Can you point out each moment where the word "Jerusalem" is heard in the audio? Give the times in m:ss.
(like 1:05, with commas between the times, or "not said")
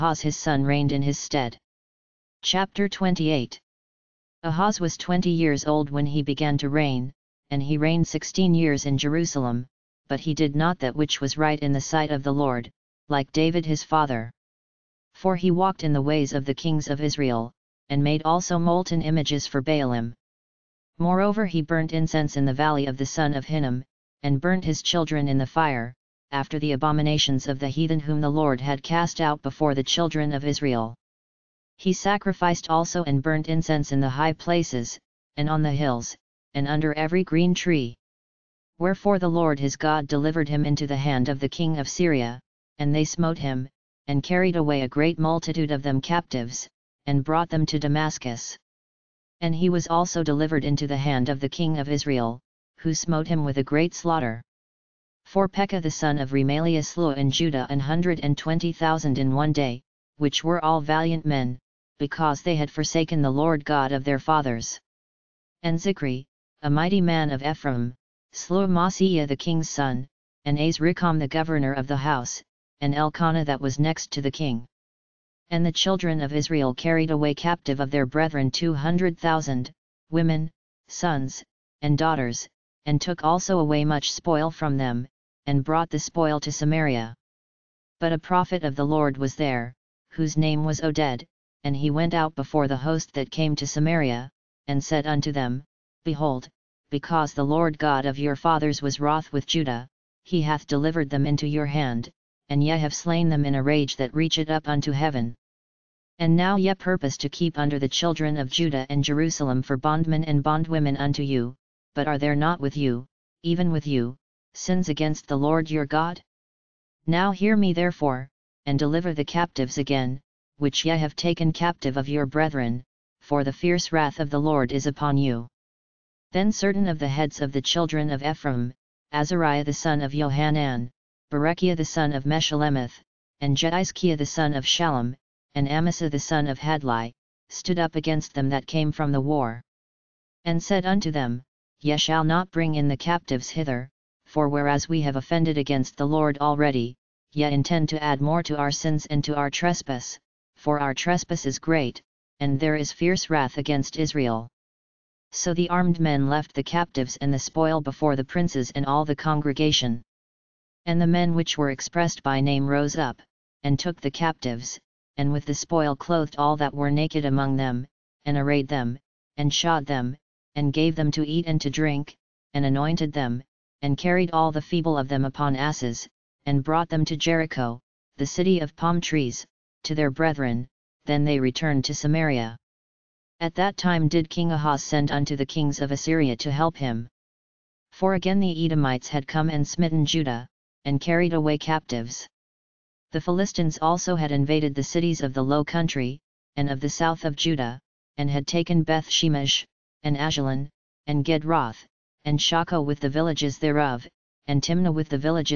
0:08, 1:49.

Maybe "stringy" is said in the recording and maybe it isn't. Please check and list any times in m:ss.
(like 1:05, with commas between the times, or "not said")
not said.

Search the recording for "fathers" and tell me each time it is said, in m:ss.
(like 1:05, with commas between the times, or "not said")
0:13, 1:04, 1:38.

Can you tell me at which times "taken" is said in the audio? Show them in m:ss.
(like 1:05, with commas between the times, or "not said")
2:01, 3:18.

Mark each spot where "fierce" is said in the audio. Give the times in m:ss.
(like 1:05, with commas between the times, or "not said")
2:03, 2:32.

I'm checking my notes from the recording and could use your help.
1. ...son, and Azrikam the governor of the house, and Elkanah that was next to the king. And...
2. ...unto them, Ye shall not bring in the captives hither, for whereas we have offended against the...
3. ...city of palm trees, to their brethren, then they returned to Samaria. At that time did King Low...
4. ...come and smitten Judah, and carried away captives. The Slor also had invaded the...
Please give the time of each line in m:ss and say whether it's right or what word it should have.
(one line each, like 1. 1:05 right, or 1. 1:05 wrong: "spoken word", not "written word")
1. 1:09 right
2. 2:20 right
3. 2:58 wrong: "Ahaz", not "Low"
4. 3:09 wrong: "Philistines", not "Slor".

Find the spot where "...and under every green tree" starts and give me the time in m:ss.
0:36.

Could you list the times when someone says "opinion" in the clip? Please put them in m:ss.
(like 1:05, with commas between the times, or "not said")
not said.